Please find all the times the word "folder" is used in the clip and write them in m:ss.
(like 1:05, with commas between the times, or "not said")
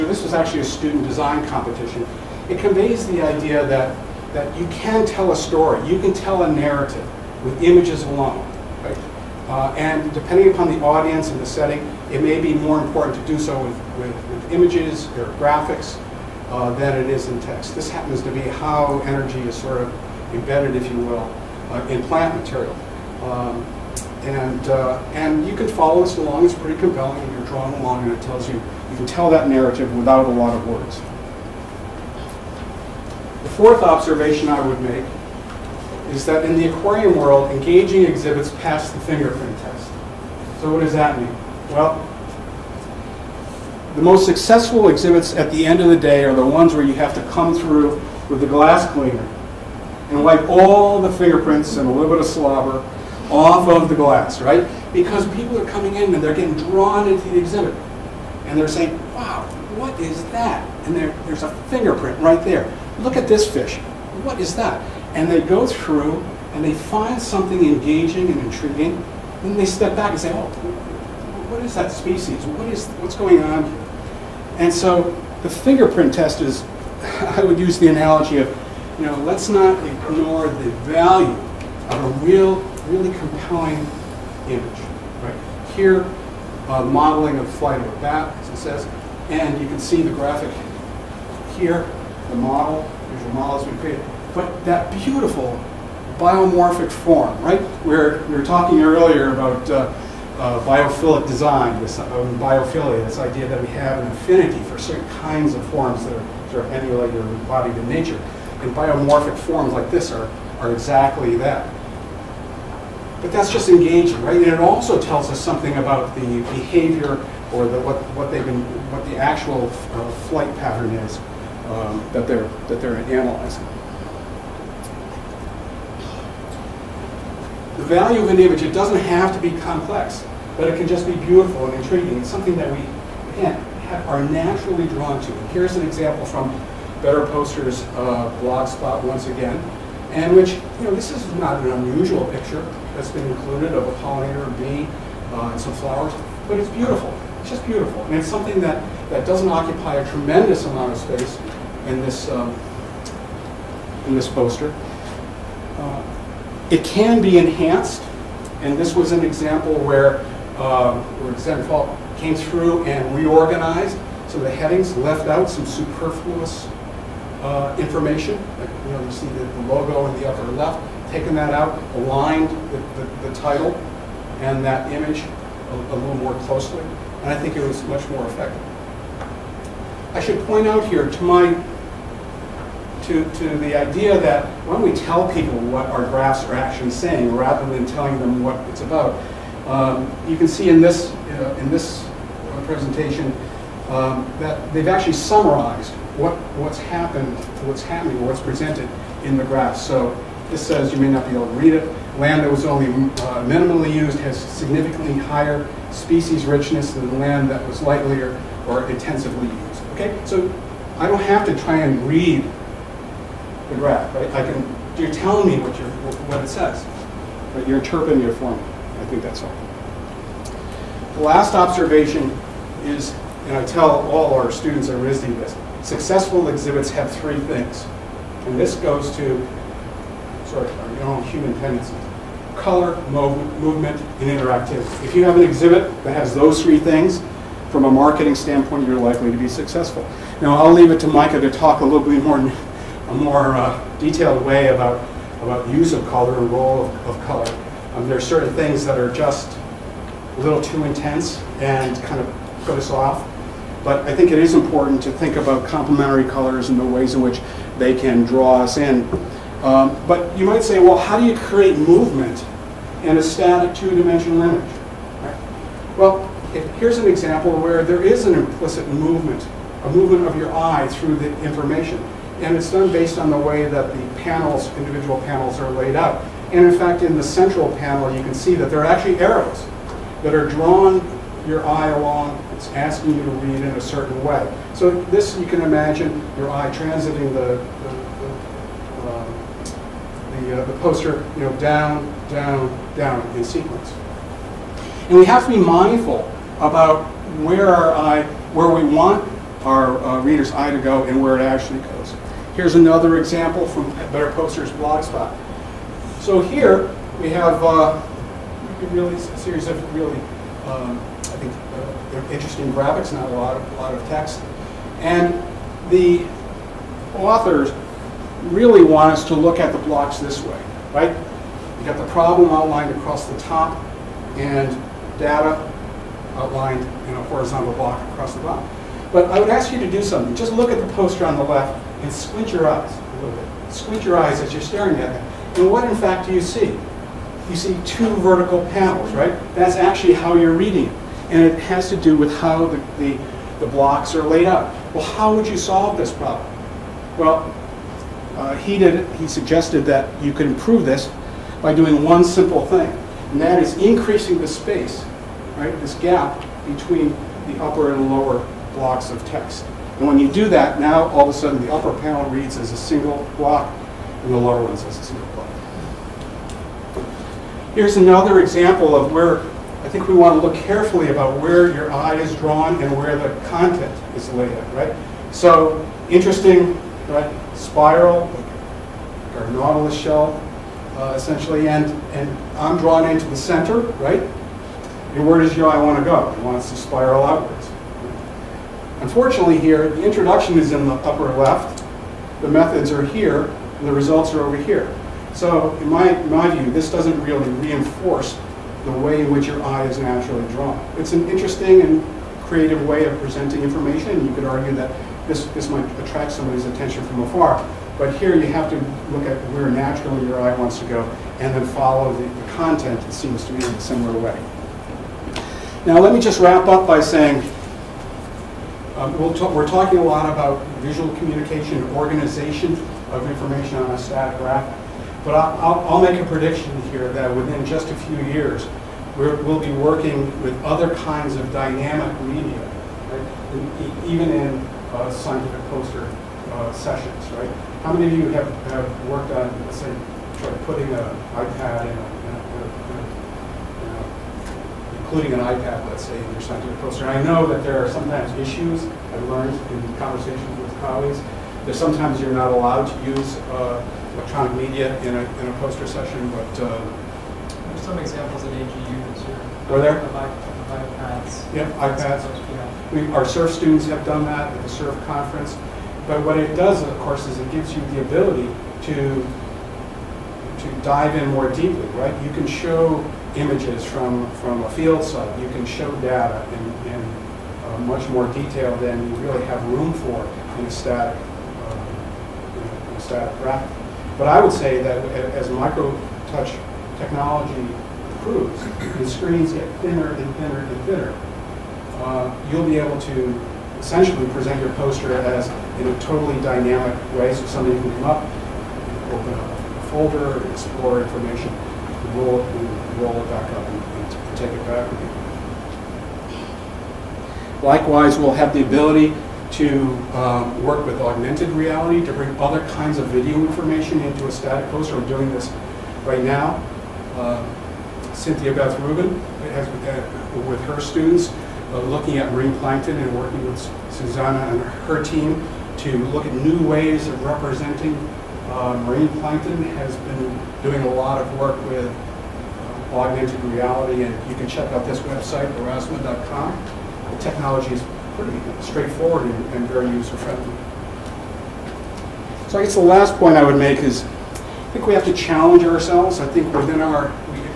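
8:19.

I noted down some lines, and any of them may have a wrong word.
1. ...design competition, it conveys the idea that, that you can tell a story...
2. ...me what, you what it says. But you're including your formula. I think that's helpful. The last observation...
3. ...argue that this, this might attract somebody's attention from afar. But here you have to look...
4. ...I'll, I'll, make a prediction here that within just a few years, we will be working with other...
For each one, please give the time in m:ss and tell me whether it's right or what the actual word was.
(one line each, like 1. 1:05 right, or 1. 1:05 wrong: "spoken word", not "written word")
1. 0:01 right
2. 3:35 wrong: "interpreting", not "including"
3. 6:44 right
4. 7:05 right.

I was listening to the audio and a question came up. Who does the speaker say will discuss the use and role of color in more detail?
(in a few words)
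Micah.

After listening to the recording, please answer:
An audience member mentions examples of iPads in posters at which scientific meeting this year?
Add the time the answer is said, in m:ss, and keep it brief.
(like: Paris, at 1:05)
AGU, at 7:38.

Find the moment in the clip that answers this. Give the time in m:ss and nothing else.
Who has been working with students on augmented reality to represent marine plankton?
8:38.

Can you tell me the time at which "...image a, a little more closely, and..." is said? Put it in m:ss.
2:54.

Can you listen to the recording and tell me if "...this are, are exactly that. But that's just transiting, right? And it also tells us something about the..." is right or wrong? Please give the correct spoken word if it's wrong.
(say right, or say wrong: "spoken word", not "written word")
wrong: "engaging", not "transiting".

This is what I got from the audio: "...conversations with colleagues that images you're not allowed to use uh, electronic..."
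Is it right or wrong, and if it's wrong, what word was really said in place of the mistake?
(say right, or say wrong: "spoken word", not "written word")
wrong: "sometimes", not "images".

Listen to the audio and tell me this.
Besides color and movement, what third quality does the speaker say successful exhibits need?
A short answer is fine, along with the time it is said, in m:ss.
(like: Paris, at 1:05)
interactivity, at 3:54.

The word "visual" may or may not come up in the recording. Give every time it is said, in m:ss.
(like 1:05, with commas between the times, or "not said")
1:33, 7:00.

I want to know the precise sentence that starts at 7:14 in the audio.
even in uh, scientific poster uh, sessions, right?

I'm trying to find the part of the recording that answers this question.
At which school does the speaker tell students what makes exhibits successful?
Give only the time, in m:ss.
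3:44.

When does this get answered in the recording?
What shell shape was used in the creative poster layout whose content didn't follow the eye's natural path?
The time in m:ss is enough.
6:19.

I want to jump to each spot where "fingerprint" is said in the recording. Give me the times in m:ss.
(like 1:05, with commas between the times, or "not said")
0:39, 0:51, 1:01, 1:15.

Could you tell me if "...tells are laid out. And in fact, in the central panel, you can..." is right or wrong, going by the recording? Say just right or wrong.
wrong.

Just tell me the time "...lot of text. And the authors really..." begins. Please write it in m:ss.
5:13.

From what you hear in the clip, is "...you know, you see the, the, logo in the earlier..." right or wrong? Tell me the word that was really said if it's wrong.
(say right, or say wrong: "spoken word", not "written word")
wrong: "upper", not "earlier".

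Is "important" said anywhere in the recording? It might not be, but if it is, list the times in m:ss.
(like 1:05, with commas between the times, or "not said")
0:12, 4:14.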